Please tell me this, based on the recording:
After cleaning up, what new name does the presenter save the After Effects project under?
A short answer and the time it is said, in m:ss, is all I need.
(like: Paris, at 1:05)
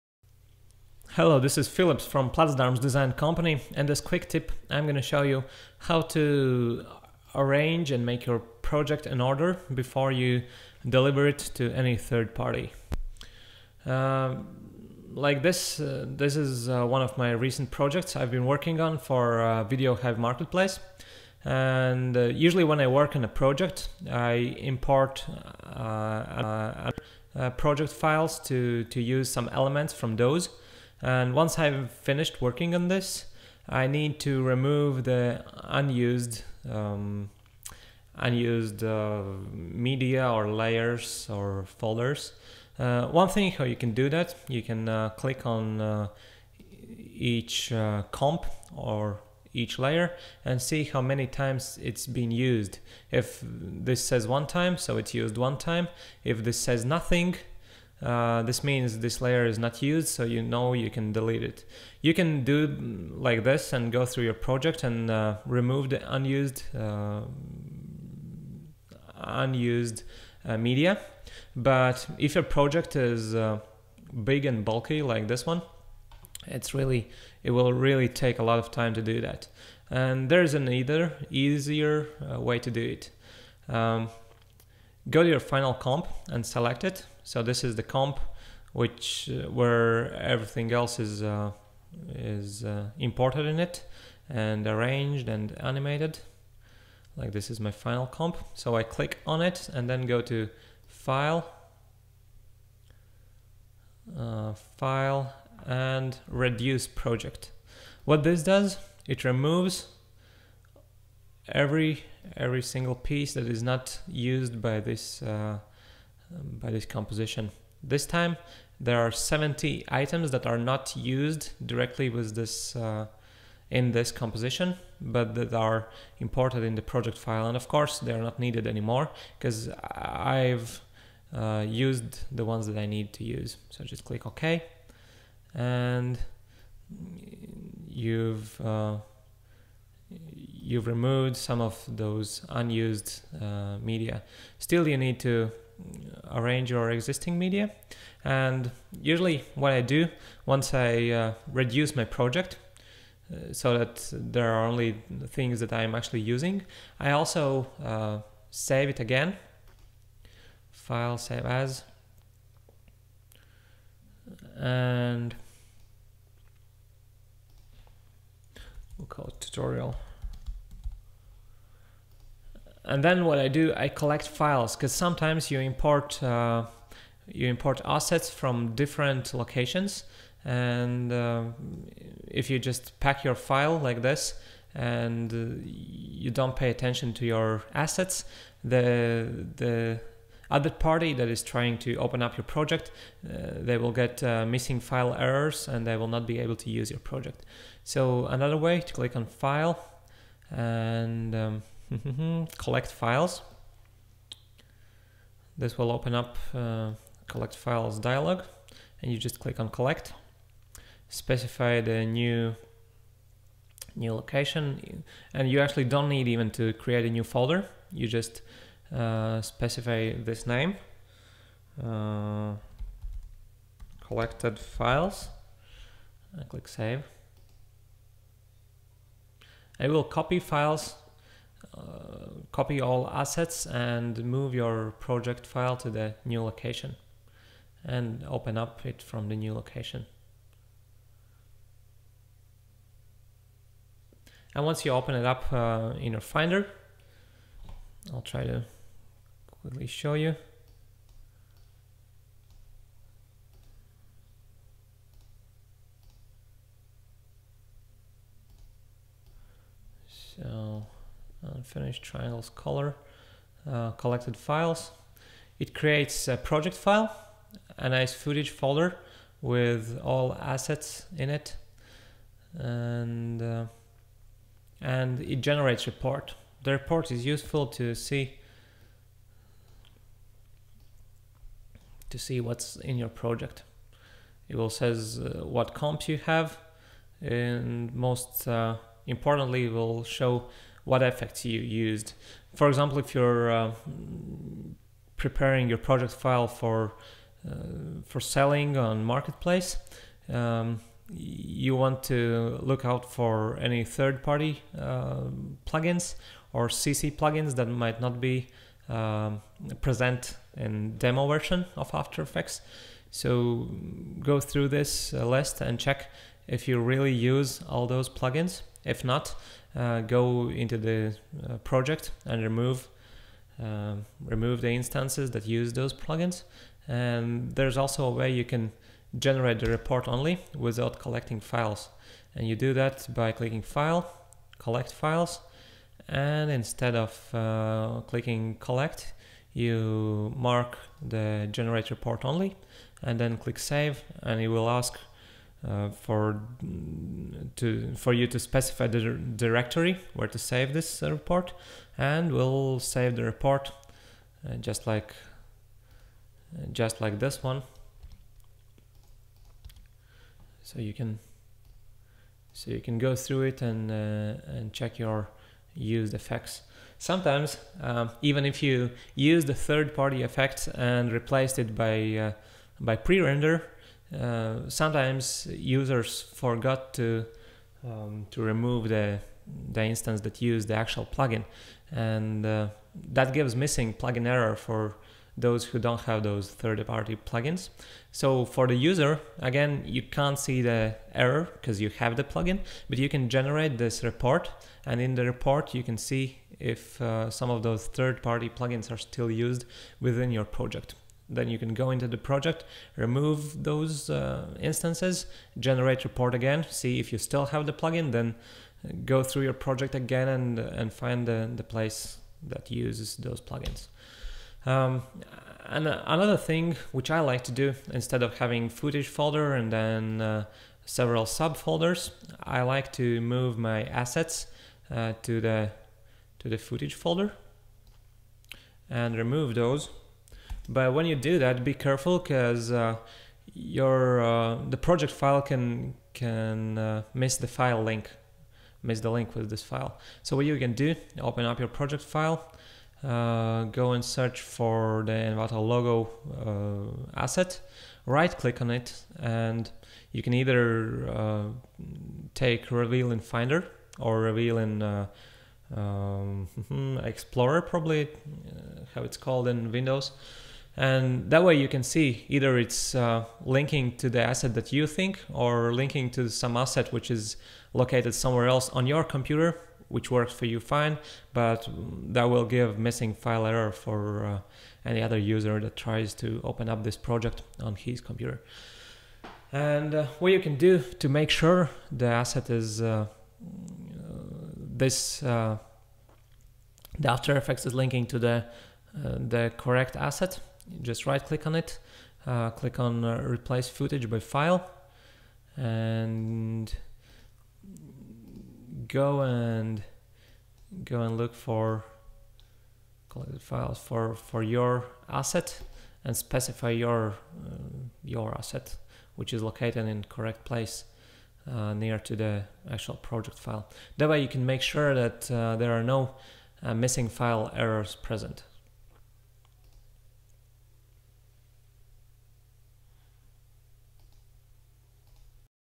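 tutorial, at 2:49.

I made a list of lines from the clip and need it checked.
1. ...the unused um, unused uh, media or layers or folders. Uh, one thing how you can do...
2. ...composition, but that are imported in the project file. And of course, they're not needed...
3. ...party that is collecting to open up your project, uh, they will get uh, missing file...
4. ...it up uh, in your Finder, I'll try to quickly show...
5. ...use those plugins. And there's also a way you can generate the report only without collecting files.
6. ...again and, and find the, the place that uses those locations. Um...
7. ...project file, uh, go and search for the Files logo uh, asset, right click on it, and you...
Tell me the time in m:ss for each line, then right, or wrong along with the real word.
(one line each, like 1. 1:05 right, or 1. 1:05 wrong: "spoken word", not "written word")
1. 0:35 right
2. 2:04 right
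3. 3:10 wrong: "trying", not "collecting"
4. 4:05 right
5. 5:25 right
6. 6:49 wrong: "plugins", not "locations"
7. 7:21 wrong: "Envato", not "Files".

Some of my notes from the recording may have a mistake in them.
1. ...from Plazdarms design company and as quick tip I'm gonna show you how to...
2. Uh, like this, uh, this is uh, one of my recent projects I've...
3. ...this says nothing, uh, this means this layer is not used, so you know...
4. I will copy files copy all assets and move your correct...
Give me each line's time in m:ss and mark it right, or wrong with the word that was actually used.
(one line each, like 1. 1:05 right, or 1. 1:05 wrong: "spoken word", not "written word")
1. 0:02 right
2. 0:13 right
3. 0:56 right
4. 3:49 wrong: "project", not "correct".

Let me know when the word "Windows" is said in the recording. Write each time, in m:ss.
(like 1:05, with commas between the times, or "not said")
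7:39.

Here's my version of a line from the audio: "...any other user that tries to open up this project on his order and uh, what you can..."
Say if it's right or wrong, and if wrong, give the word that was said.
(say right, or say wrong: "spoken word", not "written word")
wrong: "computer", not "order".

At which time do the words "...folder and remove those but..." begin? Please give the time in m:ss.
7:06.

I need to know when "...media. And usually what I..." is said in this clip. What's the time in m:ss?
2:27.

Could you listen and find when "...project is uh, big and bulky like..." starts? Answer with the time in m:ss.
1:12.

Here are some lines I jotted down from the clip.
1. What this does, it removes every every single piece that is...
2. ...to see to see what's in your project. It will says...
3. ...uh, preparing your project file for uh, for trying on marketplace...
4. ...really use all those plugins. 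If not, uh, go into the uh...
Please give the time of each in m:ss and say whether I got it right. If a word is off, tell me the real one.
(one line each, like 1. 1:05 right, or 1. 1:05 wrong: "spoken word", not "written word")
1. 1:48 right
2. 4:37 right
3. 4:53 wrong: "selling", not "trying"
4. 5:16 right.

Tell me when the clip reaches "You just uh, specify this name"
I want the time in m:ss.
3:37.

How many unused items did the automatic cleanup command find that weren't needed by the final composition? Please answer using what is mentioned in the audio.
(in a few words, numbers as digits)
70.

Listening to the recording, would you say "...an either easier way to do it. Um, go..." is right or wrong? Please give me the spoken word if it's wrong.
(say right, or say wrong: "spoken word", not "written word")
right.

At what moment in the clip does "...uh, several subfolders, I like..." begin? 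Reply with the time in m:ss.
7:00.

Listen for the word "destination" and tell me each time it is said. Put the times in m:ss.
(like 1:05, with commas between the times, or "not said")
not said.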